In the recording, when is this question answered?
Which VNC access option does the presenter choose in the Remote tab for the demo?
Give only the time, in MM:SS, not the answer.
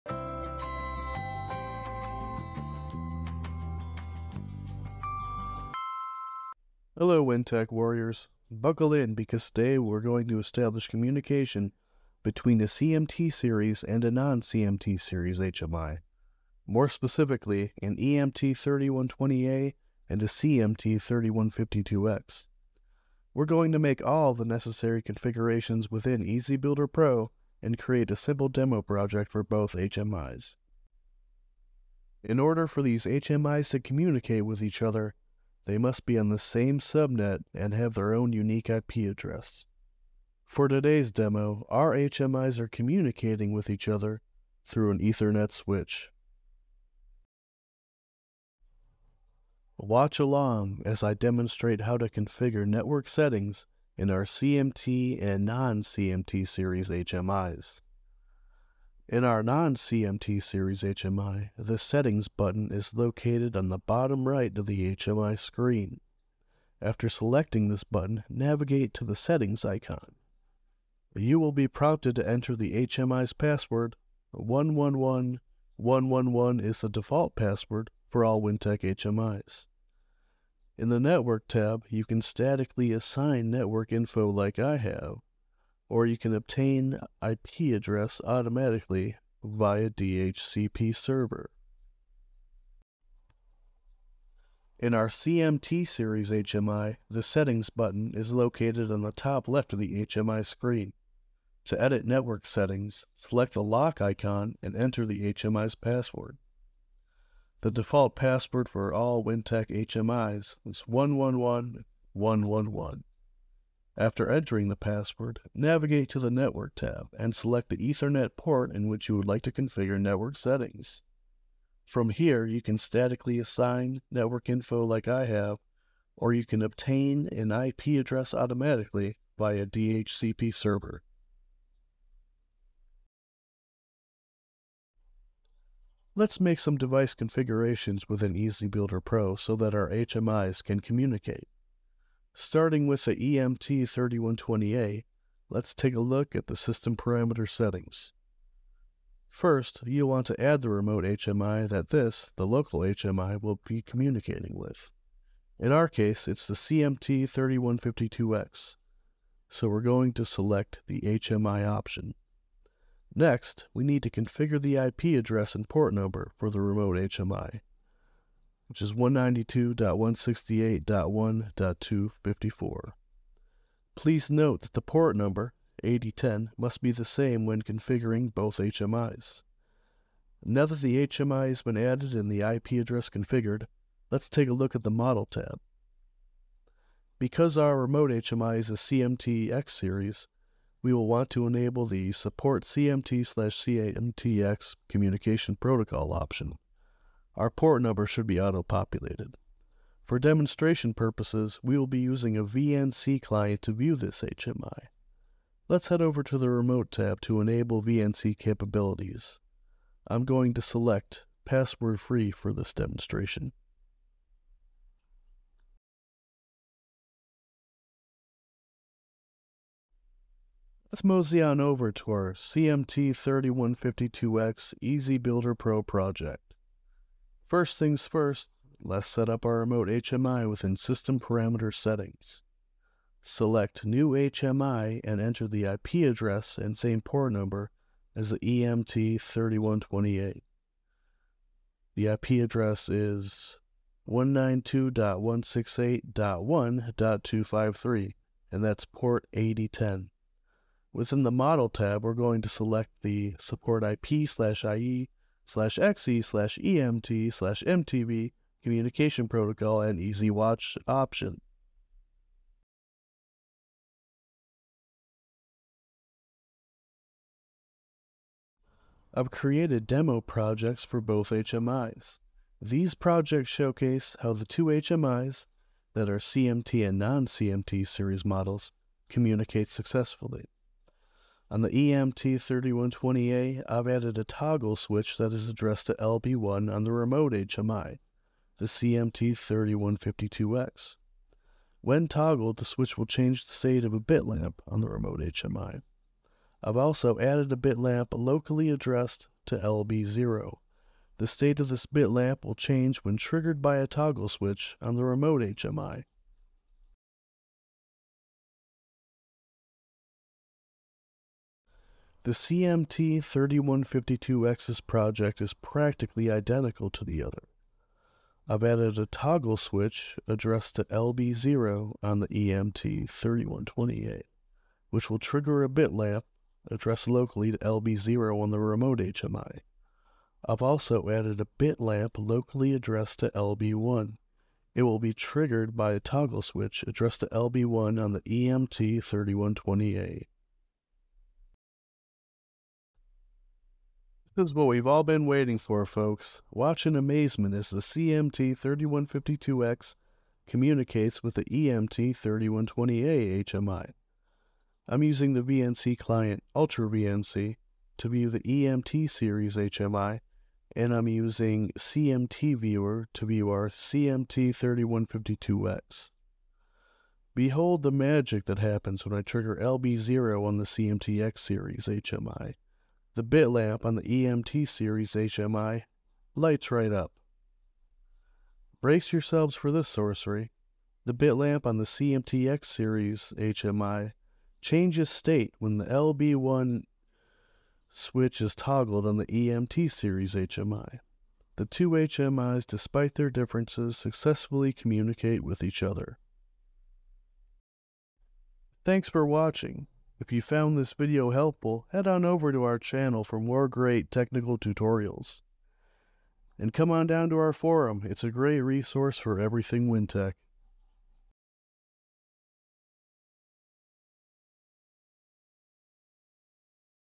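03:31.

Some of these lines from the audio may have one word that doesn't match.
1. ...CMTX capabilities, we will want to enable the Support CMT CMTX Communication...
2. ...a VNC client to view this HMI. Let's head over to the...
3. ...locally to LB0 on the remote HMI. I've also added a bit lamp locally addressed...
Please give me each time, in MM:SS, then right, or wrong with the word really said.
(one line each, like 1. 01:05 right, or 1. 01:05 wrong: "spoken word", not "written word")
1. 03:08 wrong: "series", not "capabilities"
2. 03:22 right
3. 05:27 right.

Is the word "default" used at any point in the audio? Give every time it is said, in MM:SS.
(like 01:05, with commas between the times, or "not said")
01:16, 01:47.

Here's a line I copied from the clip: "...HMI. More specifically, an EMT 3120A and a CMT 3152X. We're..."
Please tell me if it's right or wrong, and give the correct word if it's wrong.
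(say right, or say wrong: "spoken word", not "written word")
right.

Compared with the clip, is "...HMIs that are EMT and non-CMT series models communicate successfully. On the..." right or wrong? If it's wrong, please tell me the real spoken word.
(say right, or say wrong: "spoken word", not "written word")
wrong: "CMT", not "EMT".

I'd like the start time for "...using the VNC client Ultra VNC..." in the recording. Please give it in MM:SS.
05:55.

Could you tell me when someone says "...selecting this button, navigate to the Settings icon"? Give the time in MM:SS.
01:07.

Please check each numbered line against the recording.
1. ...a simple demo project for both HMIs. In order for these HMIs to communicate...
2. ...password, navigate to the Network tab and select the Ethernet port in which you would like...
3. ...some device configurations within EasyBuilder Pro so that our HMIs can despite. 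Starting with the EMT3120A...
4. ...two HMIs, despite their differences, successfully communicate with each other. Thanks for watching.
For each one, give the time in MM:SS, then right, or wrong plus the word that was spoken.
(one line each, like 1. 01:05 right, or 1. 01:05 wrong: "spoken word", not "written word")
1. 00:28 right
2. 01:54 right
3. 02:16 wrong: "communicate", not "despite"
4. 06:31 right.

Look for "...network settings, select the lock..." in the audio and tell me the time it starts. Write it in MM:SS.
01:42.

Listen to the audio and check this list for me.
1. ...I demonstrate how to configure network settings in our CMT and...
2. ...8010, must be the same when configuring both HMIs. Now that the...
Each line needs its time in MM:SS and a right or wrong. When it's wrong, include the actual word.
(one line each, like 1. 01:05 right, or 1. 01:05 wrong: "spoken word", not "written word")
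1. 00:51 right
2. 02:55 right.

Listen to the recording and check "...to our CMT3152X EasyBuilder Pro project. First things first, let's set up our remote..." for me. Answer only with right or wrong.
right.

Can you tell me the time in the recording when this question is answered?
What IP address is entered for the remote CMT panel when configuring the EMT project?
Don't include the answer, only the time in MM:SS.
02:48.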